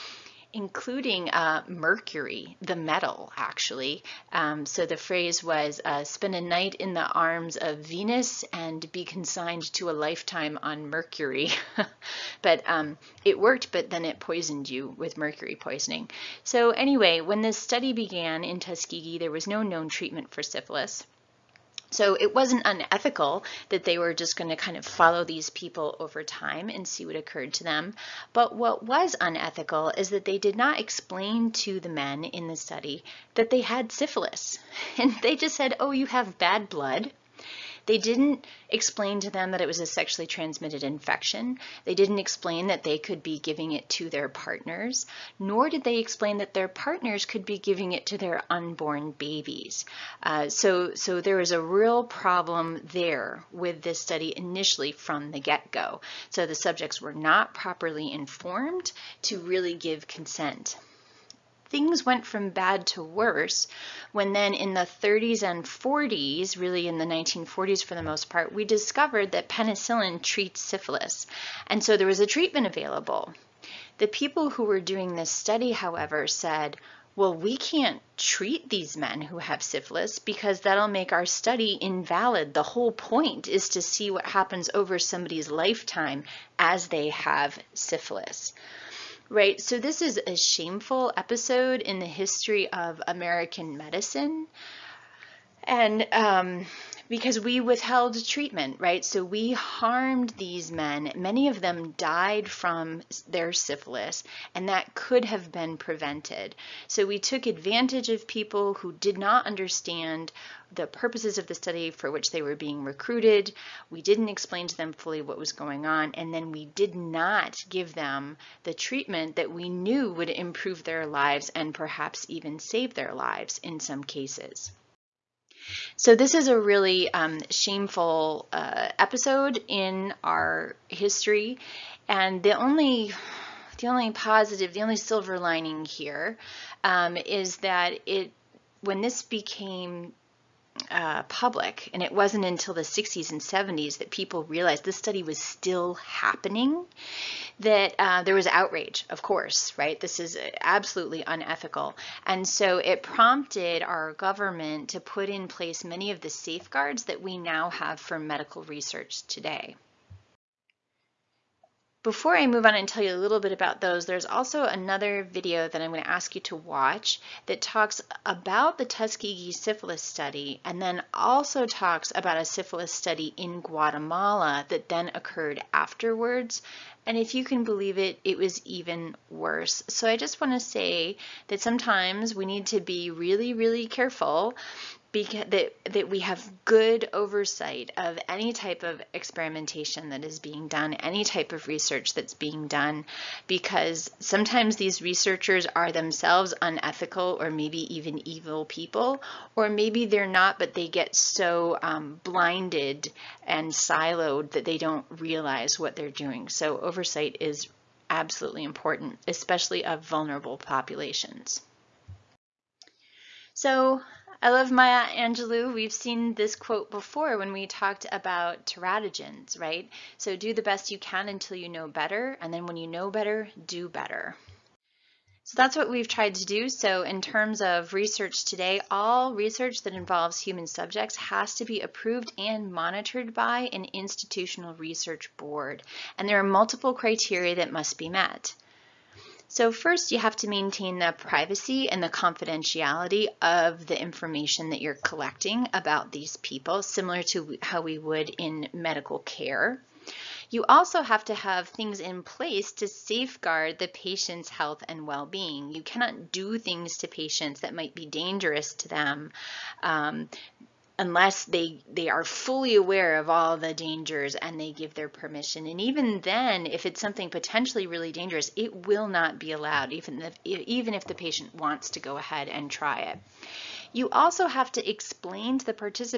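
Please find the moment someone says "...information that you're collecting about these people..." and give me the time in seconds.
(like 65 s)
244 s.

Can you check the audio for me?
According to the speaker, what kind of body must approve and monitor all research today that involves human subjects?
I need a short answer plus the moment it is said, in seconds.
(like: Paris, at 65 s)
institutional research board, at 233 s.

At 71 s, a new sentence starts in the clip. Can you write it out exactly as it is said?
And so there was a treatment available.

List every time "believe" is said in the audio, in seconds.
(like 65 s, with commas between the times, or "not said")
177 s.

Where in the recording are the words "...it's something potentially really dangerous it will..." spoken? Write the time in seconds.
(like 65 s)
266 s.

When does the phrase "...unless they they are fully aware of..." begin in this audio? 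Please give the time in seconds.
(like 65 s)
261 s.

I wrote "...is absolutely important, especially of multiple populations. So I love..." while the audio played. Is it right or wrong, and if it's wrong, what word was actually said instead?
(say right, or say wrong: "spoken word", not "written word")
wrong: "vulnerable", not "multiple".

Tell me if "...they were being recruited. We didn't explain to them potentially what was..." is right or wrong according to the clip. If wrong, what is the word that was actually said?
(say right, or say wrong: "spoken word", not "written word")
wrong: "fully", not "potentially".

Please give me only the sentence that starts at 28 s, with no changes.
But what was unethical is that they did not explain to the men in the study that they had syphilis.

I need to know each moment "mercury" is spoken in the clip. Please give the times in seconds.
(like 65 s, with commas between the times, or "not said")
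1 s, 10 s, 15 s.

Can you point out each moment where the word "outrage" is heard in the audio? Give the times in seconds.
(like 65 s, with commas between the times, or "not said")
148 s.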